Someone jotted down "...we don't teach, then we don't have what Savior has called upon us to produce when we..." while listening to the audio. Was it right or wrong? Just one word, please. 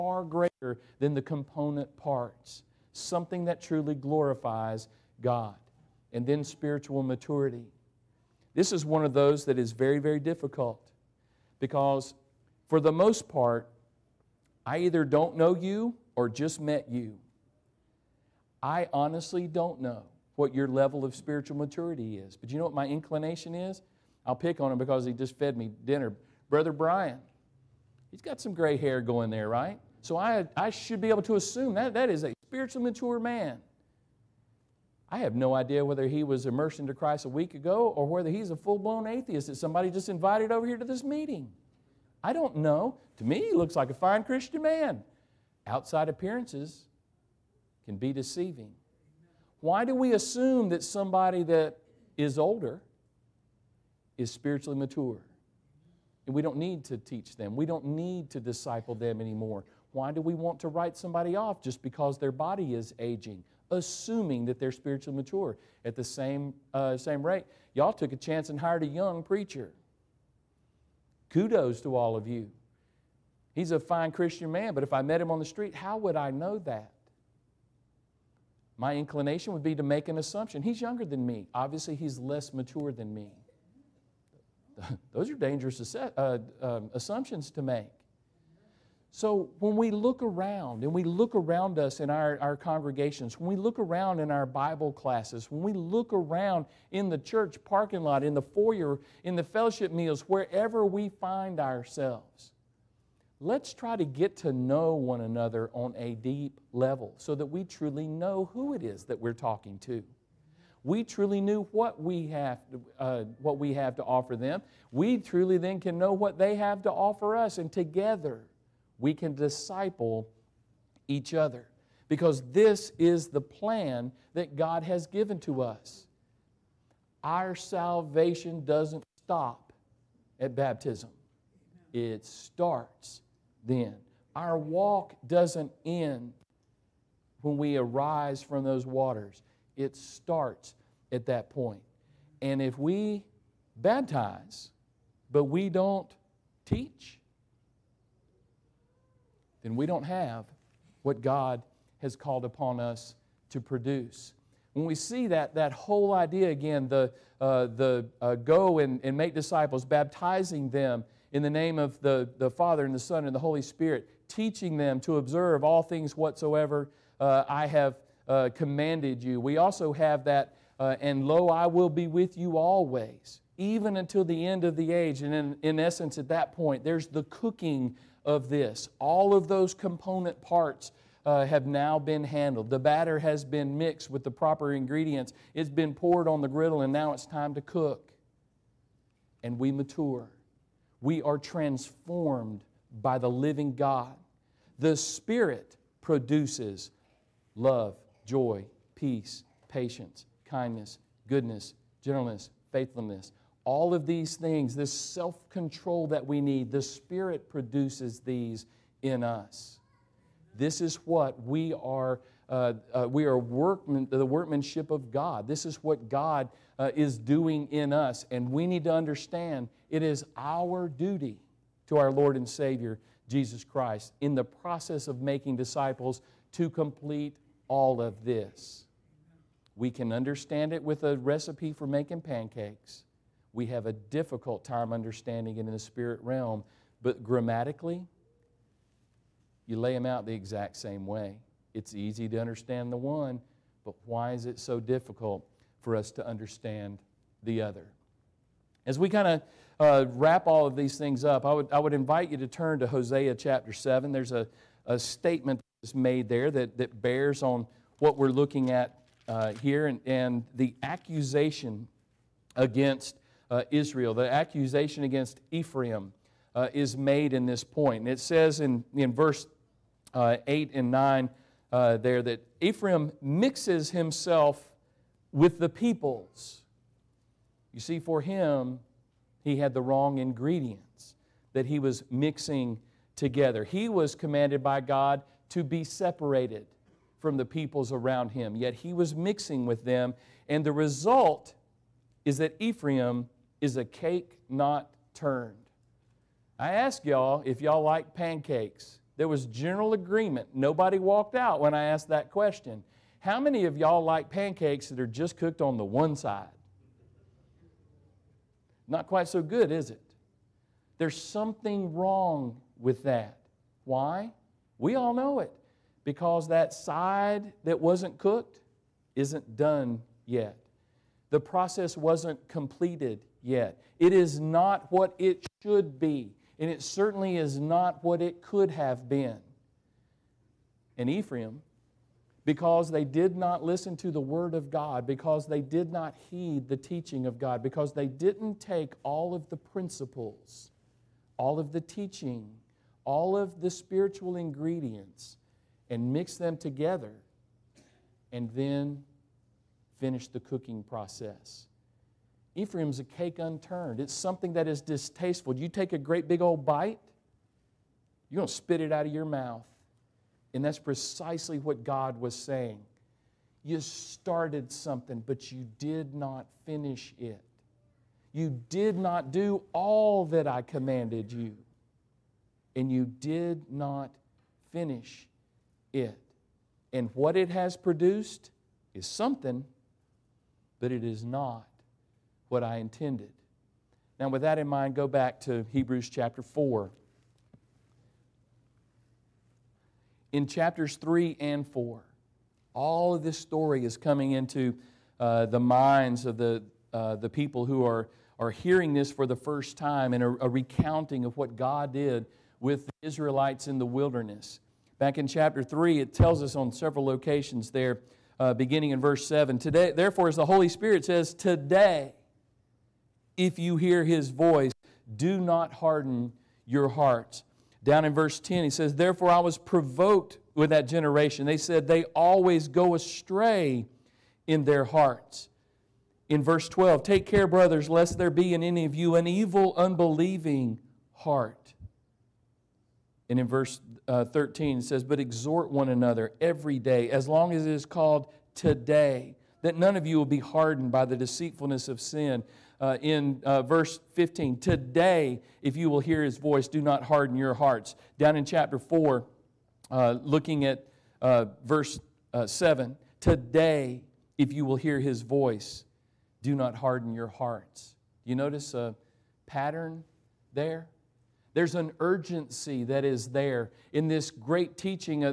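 wrong.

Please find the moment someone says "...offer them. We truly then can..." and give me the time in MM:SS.
01:54.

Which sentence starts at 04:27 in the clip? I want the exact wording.
And it says in, in verse uh, 8 and 9 uh, there that Ephraim mixes himself with the peoples.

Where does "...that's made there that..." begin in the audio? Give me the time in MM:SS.
04:15.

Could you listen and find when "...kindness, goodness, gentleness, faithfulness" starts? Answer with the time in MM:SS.
03:20.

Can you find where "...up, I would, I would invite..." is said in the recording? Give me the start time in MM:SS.
04:11.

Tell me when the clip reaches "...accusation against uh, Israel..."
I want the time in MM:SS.
04:20.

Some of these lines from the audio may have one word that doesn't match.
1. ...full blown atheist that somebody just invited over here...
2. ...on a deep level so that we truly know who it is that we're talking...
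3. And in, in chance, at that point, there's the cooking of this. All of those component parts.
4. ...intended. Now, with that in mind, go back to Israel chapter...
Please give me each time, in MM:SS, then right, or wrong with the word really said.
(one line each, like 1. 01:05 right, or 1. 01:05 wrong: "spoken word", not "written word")
1. 00:38 right
2. 01:45 right
3. 02:55 wrong: "essence", not "chance"
4. 06:22 wrong: "Hebrews", not "Israel".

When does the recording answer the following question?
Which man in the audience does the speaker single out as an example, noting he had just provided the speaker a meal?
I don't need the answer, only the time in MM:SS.
00:26.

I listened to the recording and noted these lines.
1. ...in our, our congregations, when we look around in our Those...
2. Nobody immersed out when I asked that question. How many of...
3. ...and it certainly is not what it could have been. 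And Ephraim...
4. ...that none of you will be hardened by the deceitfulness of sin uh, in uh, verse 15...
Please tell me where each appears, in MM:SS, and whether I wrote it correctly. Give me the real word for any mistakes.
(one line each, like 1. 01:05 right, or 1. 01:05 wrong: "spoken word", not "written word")
1. 01:31 wrong: "Bible", not "Those"
2. 05:00 wrong: "walked", not "immersed"
3. 05:26 right
4. 07:19 right.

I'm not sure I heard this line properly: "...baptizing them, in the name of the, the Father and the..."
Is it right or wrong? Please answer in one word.
right.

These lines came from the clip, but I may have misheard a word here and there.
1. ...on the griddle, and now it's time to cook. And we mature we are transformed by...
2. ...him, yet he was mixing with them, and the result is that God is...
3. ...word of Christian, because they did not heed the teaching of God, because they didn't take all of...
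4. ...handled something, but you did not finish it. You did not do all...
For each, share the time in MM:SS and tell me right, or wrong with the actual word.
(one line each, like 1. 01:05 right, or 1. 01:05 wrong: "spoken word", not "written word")
1. 03:06 right
2. 04:48 wrong: "Ephraim", not "God"
3. 05:34 wrong: "God", not "Christian"
4. 06:03 wrong: "started", not "handled".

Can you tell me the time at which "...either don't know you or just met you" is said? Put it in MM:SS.
00:14.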